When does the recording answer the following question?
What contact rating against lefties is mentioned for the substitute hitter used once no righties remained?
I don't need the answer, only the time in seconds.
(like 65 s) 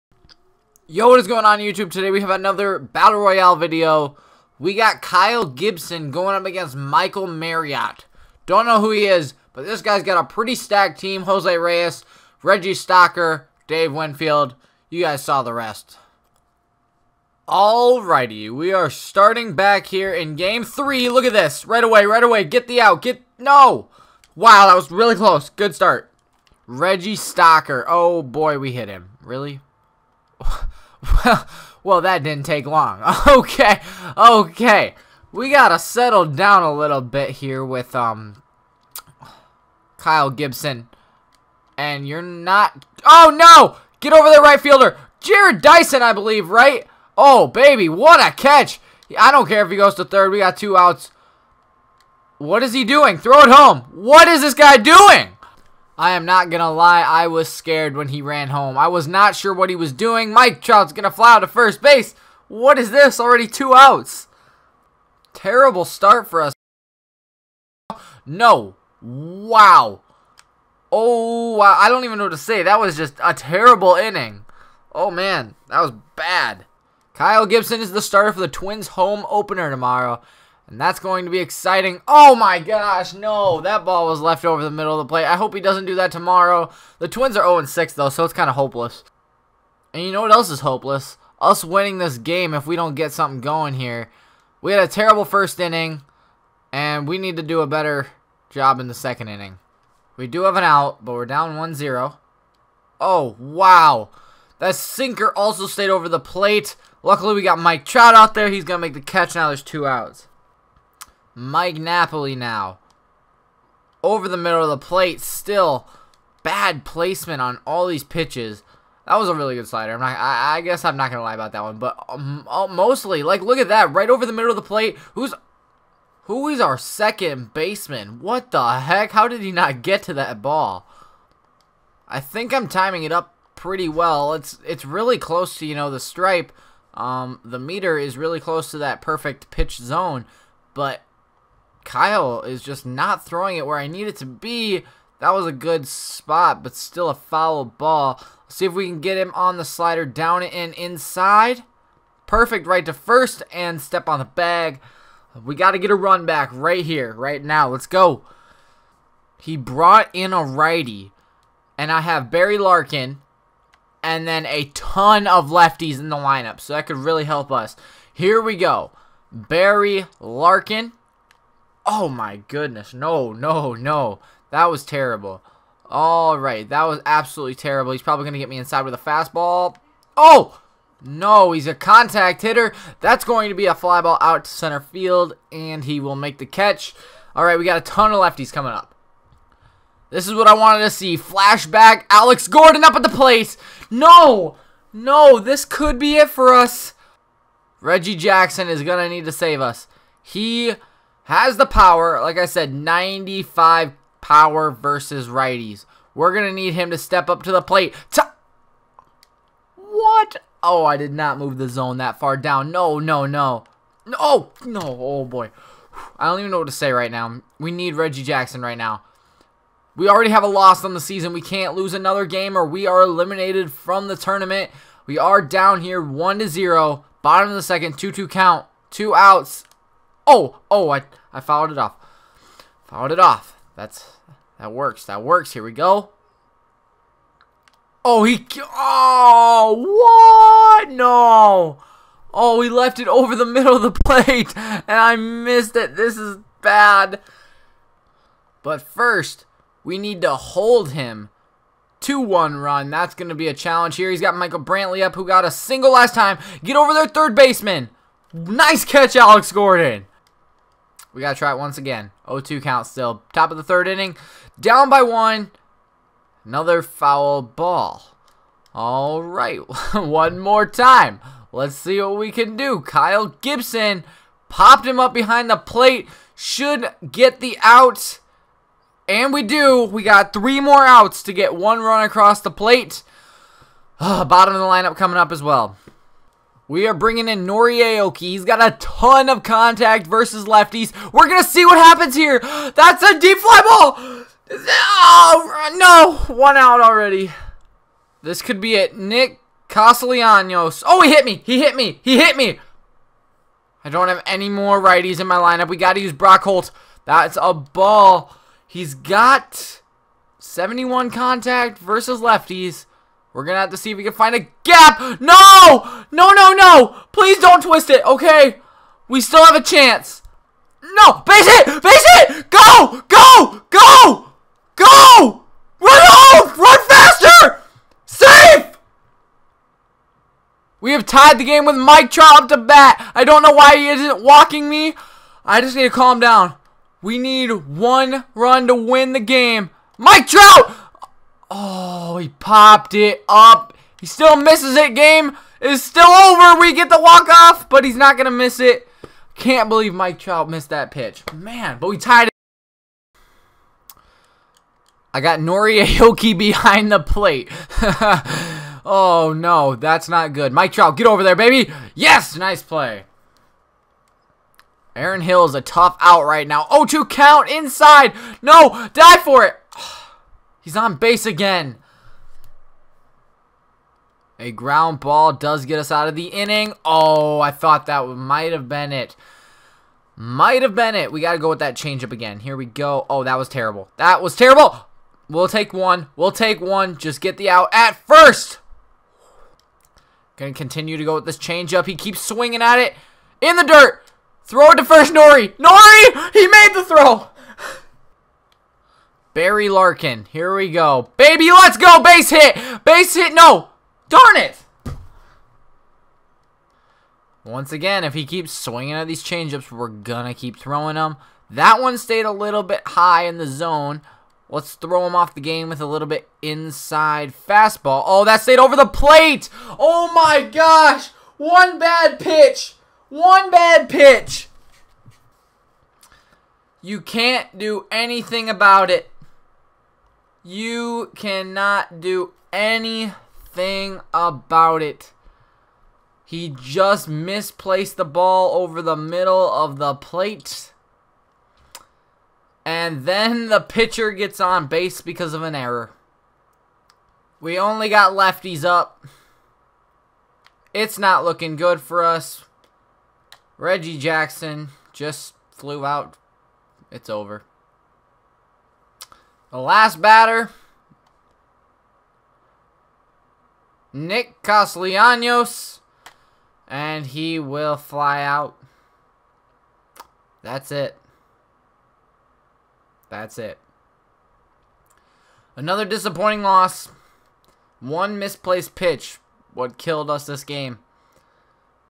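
310 s.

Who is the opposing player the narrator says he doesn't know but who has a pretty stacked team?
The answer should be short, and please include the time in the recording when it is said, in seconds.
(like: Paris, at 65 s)
Michael Marriott, at 6 s.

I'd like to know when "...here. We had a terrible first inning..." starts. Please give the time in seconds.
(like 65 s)
93 s.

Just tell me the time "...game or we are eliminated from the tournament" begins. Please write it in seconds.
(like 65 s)
222 s.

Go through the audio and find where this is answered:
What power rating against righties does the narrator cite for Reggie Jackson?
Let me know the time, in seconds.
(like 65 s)
202 s.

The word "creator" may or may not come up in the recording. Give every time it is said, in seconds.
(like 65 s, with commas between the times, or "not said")
not said.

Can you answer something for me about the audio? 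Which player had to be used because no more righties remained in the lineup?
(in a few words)
Brock Holt.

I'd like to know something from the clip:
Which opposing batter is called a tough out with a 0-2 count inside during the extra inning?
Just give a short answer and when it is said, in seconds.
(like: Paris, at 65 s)
Aaron Hill, at 364 s.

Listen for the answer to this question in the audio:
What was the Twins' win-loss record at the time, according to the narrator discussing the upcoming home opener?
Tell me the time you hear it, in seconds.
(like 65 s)
87 s.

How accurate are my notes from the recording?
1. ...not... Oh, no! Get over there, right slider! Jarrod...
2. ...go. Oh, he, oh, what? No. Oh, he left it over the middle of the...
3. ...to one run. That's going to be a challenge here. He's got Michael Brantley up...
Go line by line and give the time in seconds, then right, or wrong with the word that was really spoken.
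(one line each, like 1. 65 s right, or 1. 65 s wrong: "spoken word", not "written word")
1. 42 s wrong: "fielder", not "slider"
2. 235 s right
3. 252 s right.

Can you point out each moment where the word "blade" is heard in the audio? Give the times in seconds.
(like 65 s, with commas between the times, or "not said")
not said.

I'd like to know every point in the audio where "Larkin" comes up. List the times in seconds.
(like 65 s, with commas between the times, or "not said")
162 s, 170 s, 399 s.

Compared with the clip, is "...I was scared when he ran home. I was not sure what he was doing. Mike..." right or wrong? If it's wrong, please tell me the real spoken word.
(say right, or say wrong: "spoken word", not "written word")
right.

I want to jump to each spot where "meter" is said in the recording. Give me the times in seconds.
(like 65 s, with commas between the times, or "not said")
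137 s.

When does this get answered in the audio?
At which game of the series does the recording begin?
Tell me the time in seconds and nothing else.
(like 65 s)
20 s.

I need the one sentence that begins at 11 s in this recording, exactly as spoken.
Jose Reyes, Reggie Stocker, Dave Winfield.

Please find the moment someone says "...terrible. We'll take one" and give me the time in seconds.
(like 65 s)
384 s.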